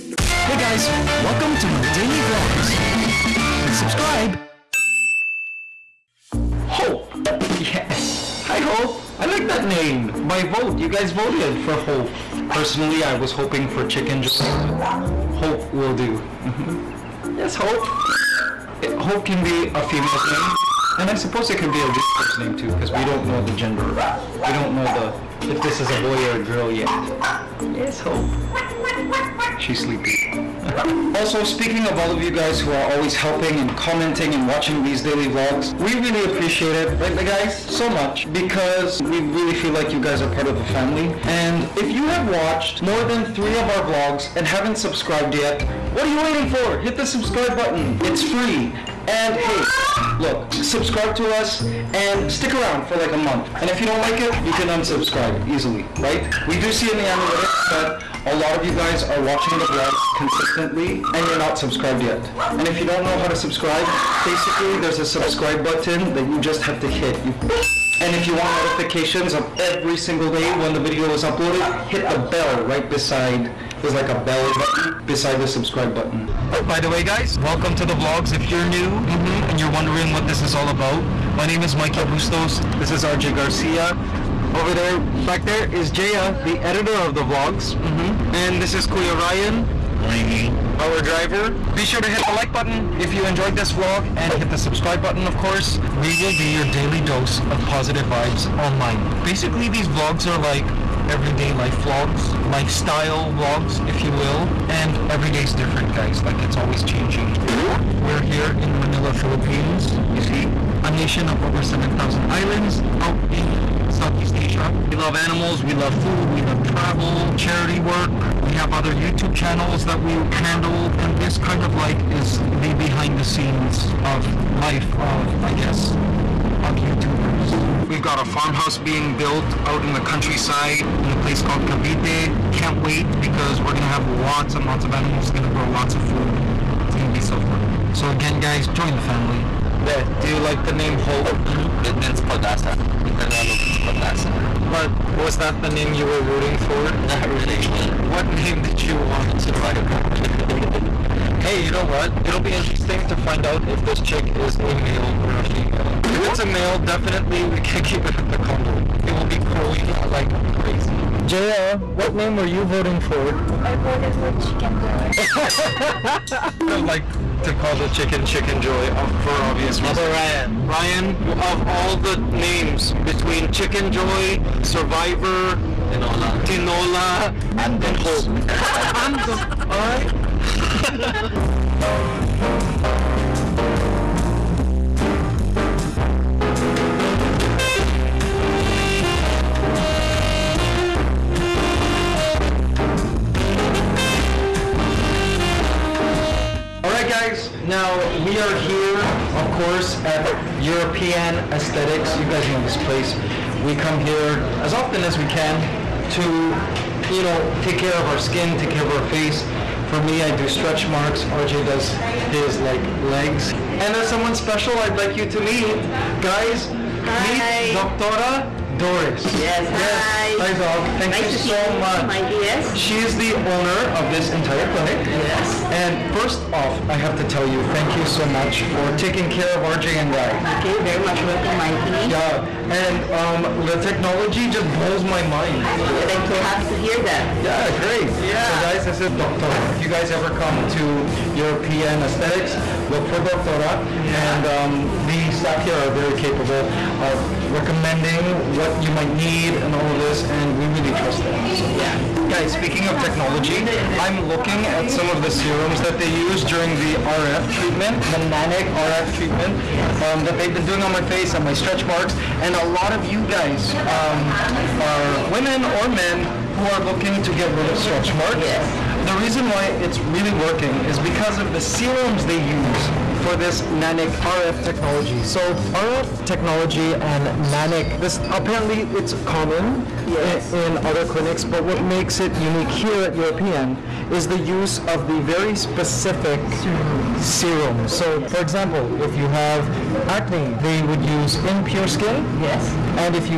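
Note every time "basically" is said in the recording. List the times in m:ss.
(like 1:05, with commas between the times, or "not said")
1:04, 1:39.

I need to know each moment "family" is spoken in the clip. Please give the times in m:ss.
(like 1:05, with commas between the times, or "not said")
0:40, 2:18.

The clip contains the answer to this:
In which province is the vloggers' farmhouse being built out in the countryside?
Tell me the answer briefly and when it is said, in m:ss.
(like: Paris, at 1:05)
Cavite, at 2:11.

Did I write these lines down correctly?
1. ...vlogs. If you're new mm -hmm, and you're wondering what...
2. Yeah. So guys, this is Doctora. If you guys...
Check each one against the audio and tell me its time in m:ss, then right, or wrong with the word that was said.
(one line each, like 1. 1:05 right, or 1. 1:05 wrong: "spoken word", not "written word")
1. 1:17 right
2. 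3:58 right.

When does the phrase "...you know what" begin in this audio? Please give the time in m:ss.
2:31.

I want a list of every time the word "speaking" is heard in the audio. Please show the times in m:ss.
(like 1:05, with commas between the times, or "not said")
0:31, 4:12.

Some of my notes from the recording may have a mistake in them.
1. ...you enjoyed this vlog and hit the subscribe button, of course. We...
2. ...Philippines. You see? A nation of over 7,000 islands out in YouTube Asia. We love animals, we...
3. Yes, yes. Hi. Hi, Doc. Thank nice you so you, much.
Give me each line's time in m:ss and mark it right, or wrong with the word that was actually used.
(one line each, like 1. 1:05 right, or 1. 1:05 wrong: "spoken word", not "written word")
1. 1:33 right
2. 1:49 wrong: "Southeast", not "YouTube"
3. 3:39 right.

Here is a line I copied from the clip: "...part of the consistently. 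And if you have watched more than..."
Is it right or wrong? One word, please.
wrong.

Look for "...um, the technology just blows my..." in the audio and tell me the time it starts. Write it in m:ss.
3:53.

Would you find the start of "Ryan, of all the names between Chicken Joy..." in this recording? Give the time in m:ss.
2:50.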